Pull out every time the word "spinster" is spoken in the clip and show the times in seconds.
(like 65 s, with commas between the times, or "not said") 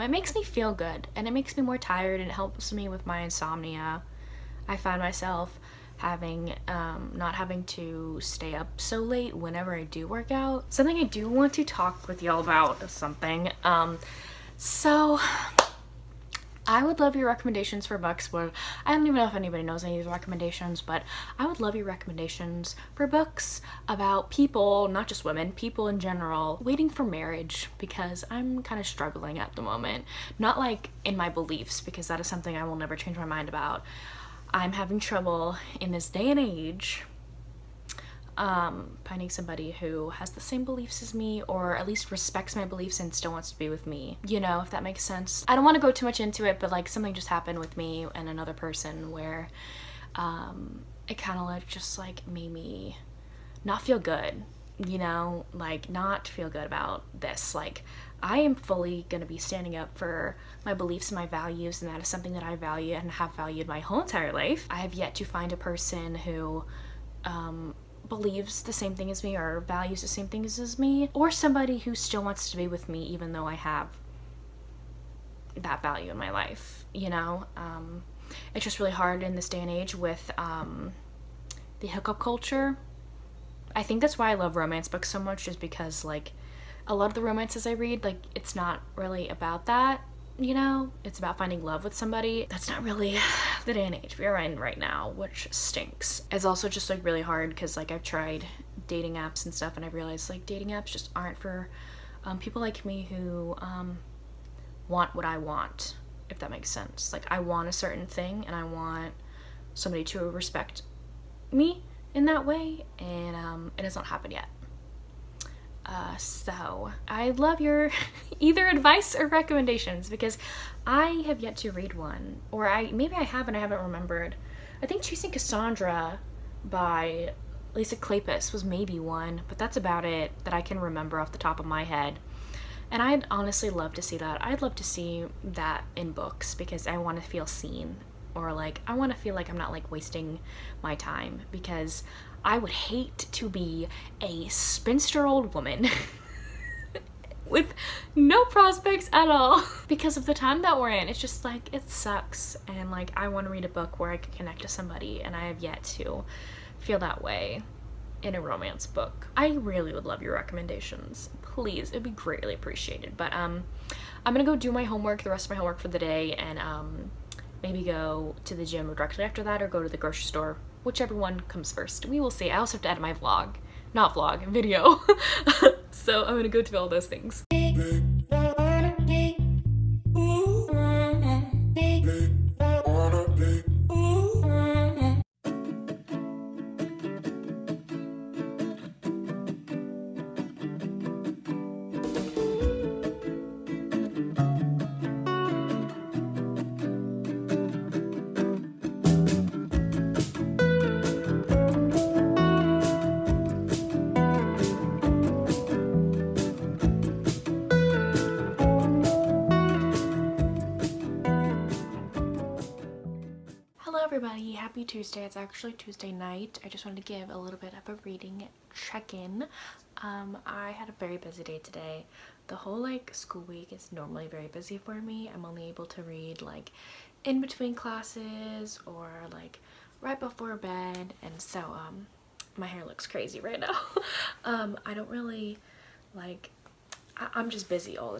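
144 s.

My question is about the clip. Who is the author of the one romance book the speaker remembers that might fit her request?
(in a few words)
Lisa Kleypas.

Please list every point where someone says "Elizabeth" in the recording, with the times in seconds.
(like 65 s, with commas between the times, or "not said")
not said.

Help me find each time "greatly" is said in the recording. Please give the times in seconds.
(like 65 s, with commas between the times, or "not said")
162 s.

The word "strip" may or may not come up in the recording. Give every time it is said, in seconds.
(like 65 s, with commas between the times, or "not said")
not said.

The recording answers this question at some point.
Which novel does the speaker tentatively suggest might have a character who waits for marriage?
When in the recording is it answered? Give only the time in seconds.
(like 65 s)
125 s.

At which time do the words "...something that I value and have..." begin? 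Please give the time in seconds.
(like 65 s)
62 s.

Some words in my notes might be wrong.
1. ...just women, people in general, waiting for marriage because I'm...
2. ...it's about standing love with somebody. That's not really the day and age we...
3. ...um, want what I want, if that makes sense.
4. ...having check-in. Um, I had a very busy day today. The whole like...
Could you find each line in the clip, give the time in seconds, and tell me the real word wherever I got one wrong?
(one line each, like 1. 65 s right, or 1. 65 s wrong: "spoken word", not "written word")
1. 25 s right
2. 91 s wrong: "finding", not "standing"
3. 103 s right
4. 218 s wrong: "reading", not "having".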